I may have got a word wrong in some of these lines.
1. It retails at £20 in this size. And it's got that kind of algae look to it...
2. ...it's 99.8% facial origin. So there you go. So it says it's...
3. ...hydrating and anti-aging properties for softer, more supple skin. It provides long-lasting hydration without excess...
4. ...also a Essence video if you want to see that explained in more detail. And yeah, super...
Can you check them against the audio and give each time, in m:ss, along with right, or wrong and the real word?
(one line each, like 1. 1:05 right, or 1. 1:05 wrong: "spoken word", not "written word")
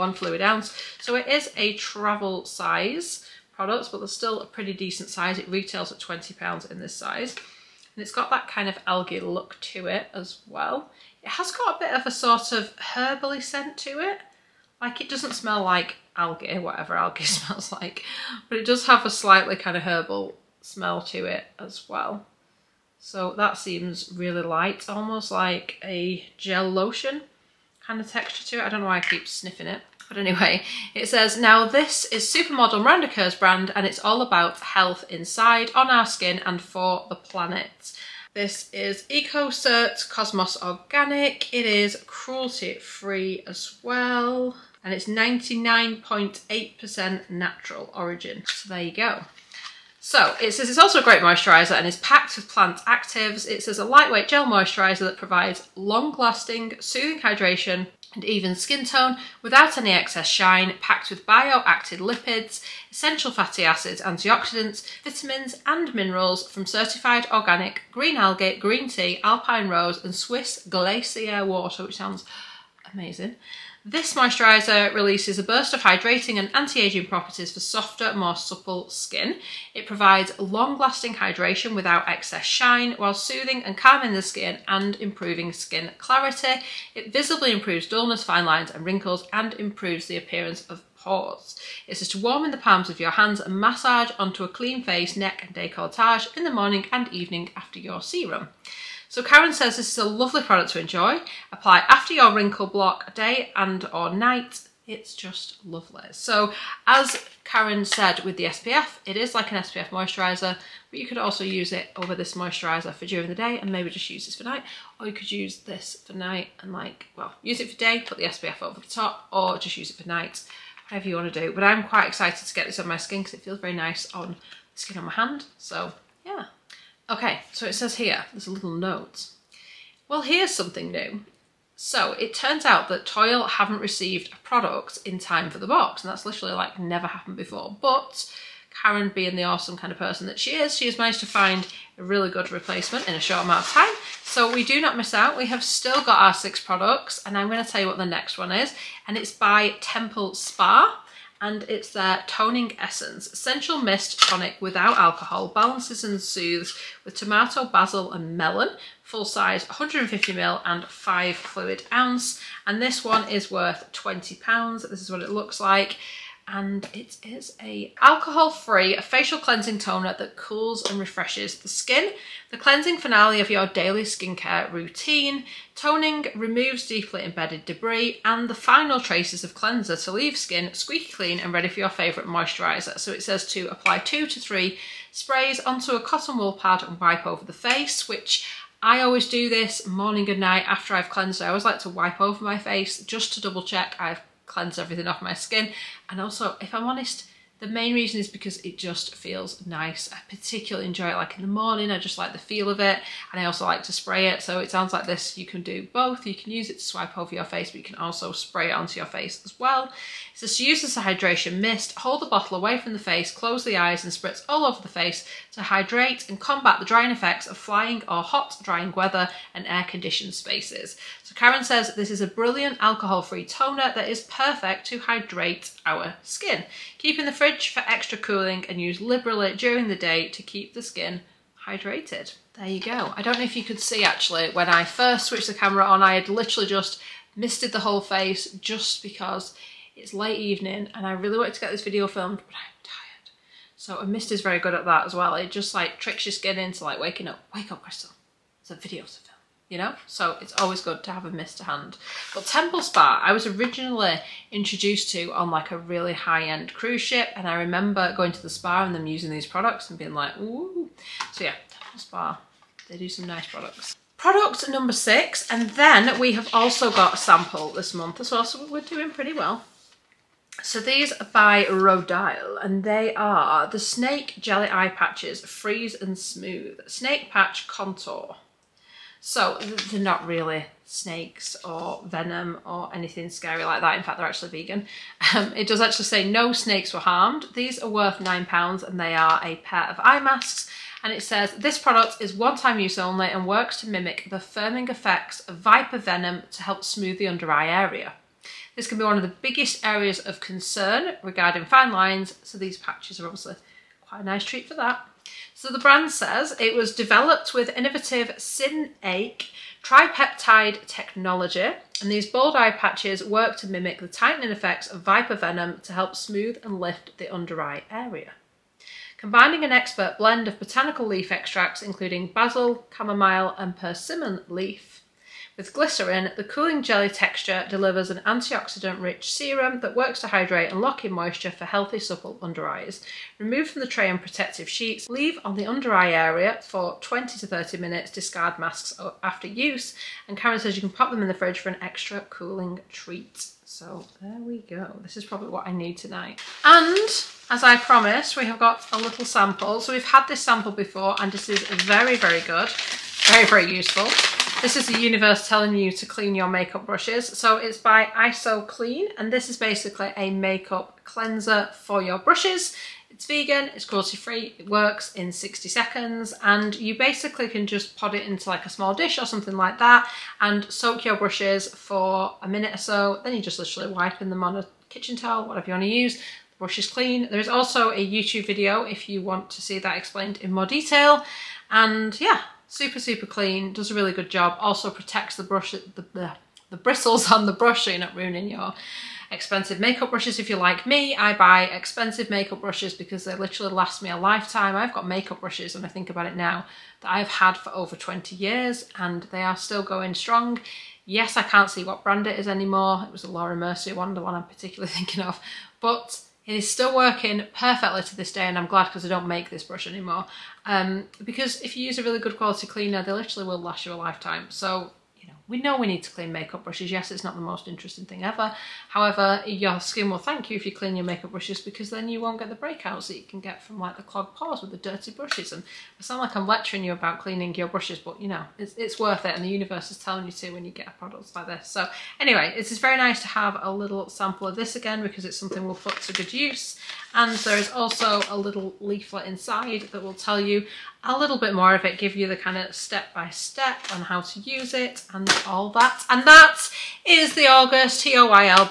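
1. 0:05 right
2. 0:44 wrong: "natural", not "facial"
3. 1:15 right
4. 6:17 wrong: "YouTube", not "Essence".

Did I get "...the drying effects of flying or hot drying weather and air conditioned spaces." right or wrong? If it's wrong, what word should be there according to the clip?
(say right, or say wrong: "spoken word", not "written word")
right.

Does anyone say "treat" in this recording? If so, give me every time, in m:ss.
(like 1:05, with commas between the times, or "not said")
5:04, 5:42.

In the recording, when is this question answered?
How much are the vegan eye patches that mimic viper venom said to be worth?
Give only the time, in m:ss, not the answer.
4:48.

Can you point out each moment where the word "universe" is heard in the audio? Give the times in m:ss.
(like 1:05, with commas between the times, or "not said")
5:54, 7:09.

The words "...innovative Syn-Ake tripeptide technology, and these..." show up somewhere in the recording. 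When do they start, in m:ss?
5:07.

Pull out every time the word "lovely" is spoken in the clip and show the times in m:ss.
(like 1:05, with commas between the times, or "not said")
1:40, 1:45.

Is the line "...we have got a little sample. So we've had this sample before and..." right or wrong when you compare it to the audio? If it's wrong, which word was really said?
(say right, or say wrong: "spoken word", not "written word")
right.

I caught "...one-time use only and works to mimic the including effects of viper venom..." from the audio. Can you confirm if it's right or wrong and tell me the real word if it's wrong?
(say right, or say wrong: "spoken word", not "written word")
wrong: "firming", not "including".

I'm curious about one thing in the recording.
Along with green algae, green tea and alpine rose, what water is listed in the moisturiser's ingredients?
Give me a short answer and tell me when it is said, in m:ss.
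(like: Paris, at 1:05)
Swiss glacier water, at 1:10.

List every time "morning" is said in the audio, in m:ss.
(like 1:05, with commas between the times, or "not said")
1:36, 3:09, 3:21.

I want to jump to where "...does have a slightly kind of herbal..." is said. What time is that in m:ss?
0:18.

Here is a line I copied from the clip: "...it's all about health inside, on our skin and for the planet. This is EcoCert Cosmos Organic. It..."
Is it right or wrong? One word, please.
right.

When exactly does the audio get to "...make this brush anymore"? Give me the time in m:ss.
6:49.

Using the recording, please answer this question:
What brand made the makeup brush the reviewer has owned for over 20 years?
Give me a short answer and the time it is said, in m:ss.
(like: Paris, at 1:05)
Laura Mercier, at 6:43.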